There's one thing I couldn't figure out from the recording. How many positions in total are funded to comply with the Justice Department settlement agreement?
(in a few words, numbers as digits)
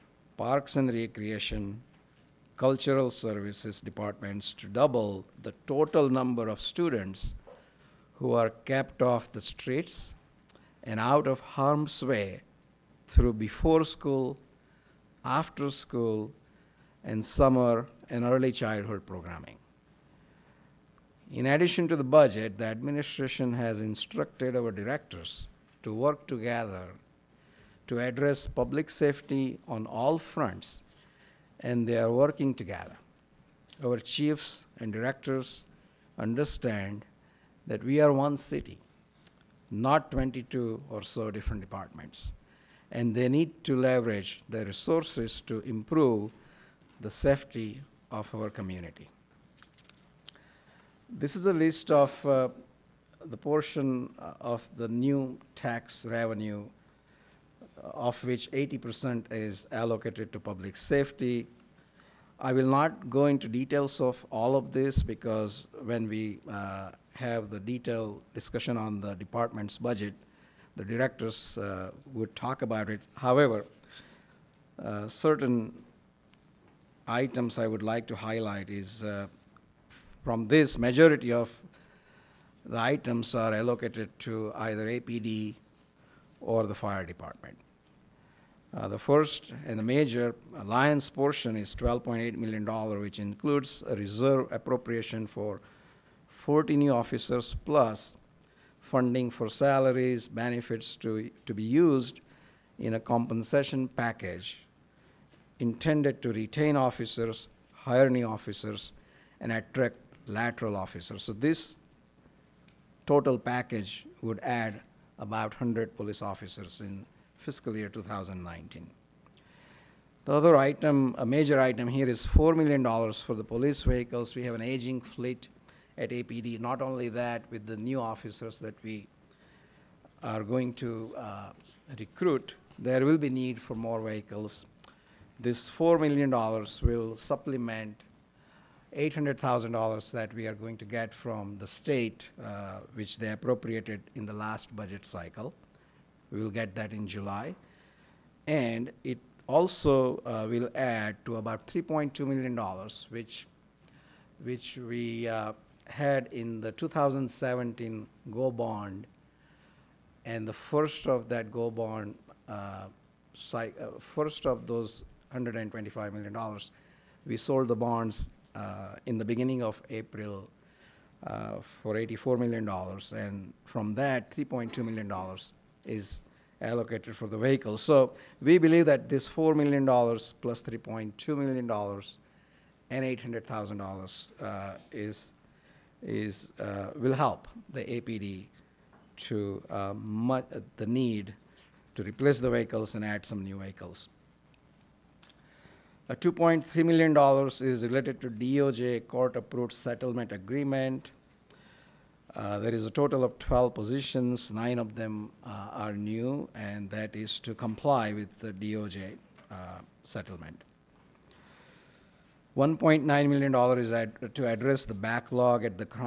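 12.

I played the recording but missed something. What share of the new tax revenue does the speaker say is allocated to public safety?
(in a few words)
80%.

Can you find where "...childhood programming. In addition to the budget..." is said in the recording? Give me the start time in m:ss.
0:18.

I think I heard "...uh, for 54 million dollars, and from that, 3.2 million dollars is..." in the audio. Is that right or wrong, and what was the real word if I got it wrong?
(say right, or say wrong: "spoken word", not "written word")
wrong: "84", not "54".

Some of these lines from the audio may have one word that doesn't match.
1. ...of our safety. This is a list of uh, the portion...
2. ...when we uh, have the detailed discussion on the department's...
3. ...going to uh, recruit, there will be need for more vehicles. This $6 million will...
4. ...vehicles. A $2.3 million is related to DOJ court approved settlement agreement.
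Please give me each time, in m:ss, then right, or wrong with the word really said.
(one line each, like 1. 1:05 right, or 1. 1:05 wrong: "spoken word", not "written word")
1. 0:48 wrong: "community", not "safety"
2. 1:05 right
3. 2:10 wrong: "4", not "6"
4. 3:13 right.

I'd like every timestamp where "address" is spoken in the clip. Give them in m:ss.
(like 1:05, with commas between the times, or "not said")
0:28, 3:34.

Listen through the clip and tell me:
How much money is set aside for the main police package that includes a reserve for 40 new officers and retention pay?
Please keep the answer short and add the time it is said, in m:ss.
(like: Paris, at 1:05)
$12.8 million, at 1:31.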